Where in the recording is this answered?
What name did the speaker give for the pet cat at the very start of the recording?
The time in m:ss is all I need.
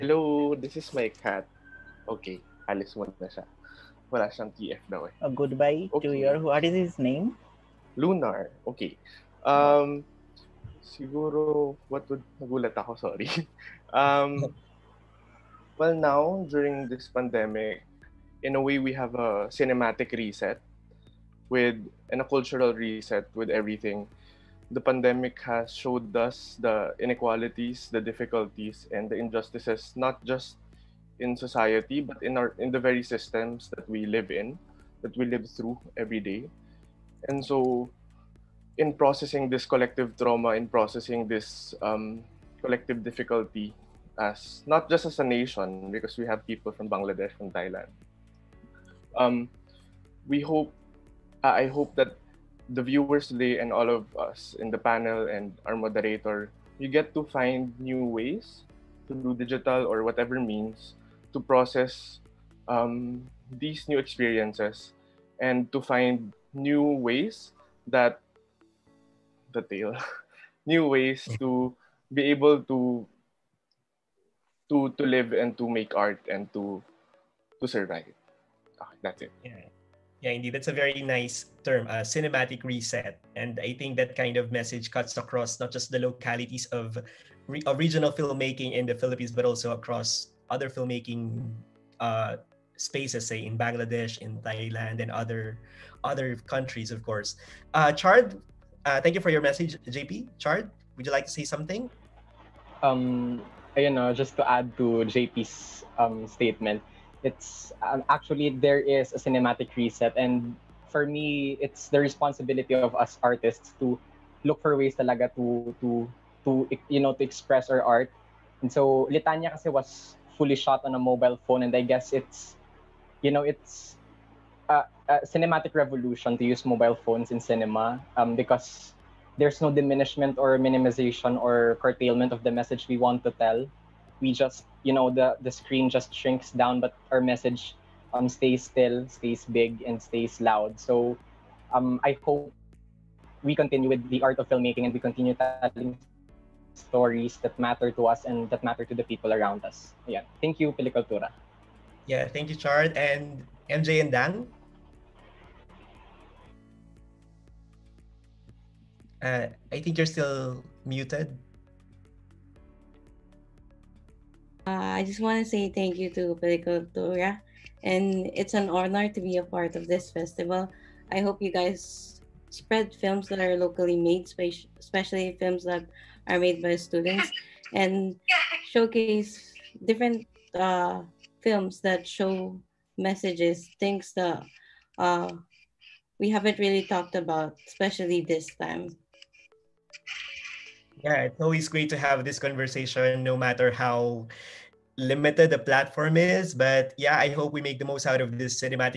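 0:07.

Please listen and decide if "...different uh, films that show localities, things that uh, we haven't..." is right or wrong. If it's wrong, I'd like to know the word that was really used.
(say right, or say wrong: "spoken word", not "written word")
wrong: "messages", not "localities".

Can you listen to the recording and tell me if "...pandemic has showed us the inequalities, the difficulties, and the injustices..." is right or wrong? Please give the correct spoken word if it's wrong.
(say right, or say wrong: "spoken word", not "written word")
right.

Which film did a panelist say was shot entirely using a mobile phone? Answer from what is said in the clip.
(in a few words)
Litanya.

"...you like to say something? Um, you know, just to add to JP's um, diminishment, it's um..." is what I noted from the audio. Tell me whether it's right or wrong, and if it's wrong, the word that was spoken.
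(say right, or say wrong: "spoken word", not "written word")
wrong: "statement", not "diminishment".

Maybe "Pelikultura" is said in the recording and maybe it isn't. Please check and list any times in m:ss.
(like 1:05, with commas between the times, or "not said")
2:30, 2:46.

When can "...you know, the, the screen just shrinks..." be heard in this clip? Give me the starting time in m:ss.
2:14.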